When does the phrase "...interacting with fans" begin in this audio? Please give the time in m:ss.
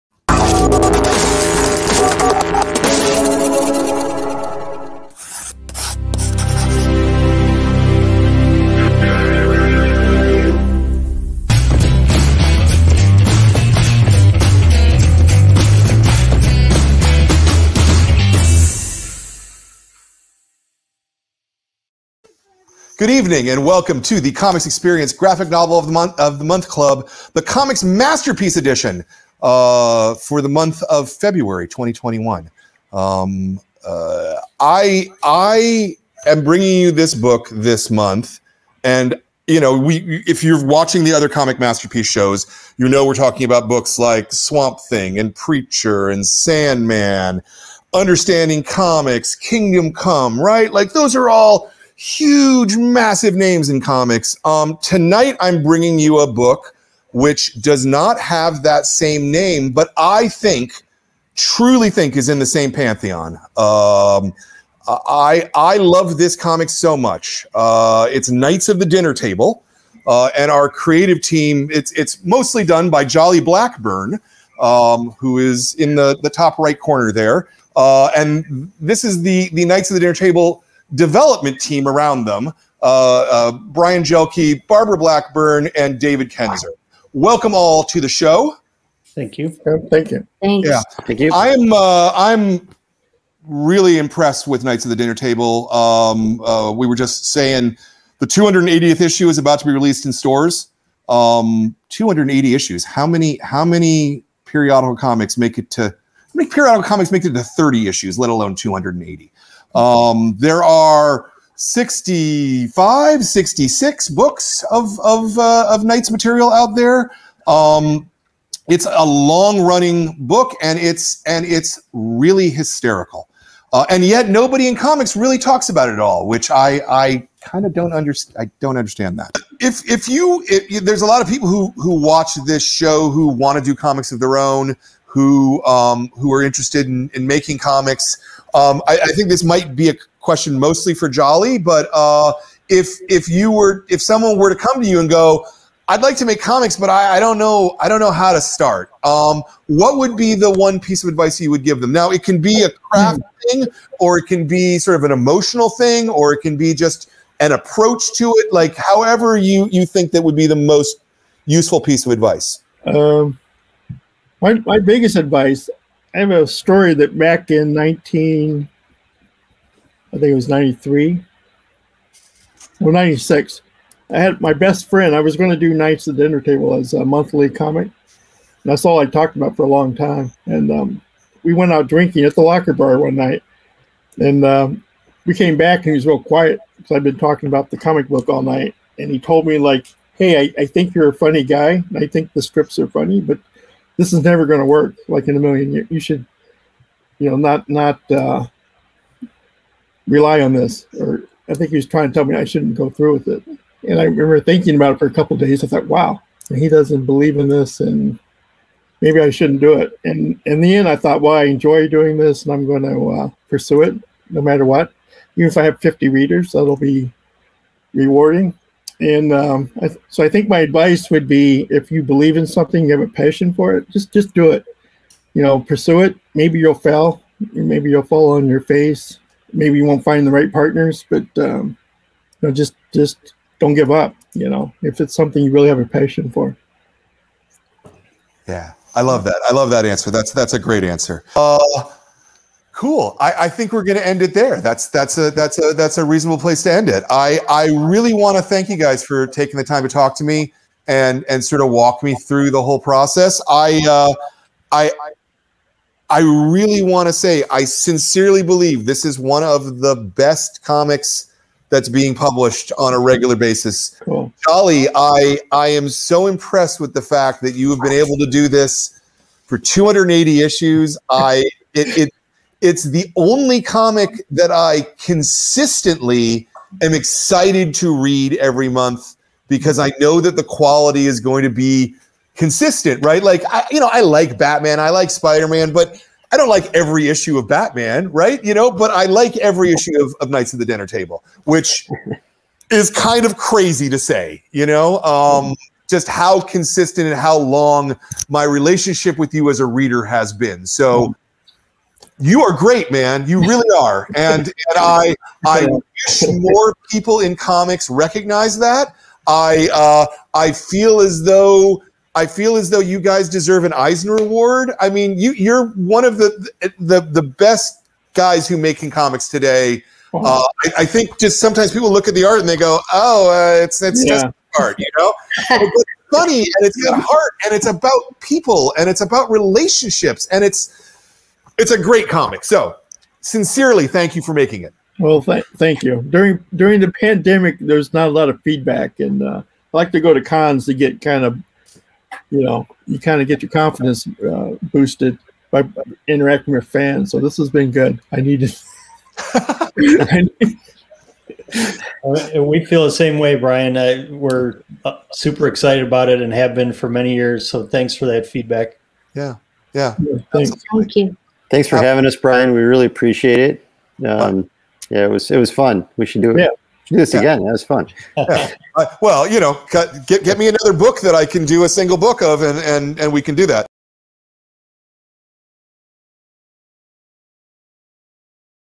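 5:46.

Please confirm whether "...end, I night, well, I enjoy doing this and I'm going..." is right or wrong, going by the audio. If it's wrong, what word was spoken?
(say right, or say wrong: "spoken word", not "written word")
wrong: "thought", not "night".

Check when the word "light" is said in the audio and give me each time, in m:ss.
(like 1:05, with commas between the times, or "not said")
not said.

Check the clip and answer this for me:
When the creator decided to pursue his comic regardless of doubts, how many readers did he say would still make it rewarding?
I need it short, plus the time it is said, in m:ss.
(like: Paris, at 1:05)
50, at 3:35.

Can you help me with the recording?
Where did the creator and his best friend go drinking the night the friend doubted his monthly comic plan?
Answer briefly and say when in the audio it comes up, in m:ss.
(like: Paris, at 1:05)
the locker bar, at 3:02.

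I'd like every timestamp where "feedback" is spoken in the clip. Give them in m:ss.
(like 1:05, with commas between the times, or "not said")
5:38, 5:58.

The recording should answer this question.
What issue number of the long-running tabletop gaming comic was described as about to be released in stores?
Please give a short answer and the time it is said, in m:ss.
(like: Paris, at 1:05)
280, at 1:38.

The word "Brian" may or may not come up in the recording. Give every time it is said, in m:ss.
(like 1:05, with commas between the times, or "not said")
1:23, 5:53, 6:02.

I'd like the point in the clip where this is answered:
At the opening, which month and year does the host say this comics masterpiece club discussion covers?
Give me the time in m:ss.
0:31.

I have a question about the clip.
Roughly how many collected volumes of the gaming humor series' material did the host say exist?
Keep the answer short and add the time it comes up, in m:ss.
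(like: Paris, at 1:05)
65, at 1:51.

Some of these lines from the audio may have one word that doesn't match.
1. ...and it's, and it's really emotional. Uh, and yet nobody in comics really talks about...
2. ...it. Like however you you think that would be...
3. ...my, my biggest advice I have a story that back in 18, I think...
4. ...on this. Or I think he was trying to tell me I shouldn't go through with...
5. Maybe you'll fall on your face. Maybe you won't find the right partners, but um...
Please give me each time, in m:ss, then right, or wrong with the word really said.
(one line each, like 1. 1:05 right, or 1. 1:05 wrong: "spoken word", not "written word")
1. 2:00 wrong: "hysterical", not "emotional"
2. 2:38 right
3. 2:44 wrong: "19", not "18"
4. 3:20 right
5. 3:47 right.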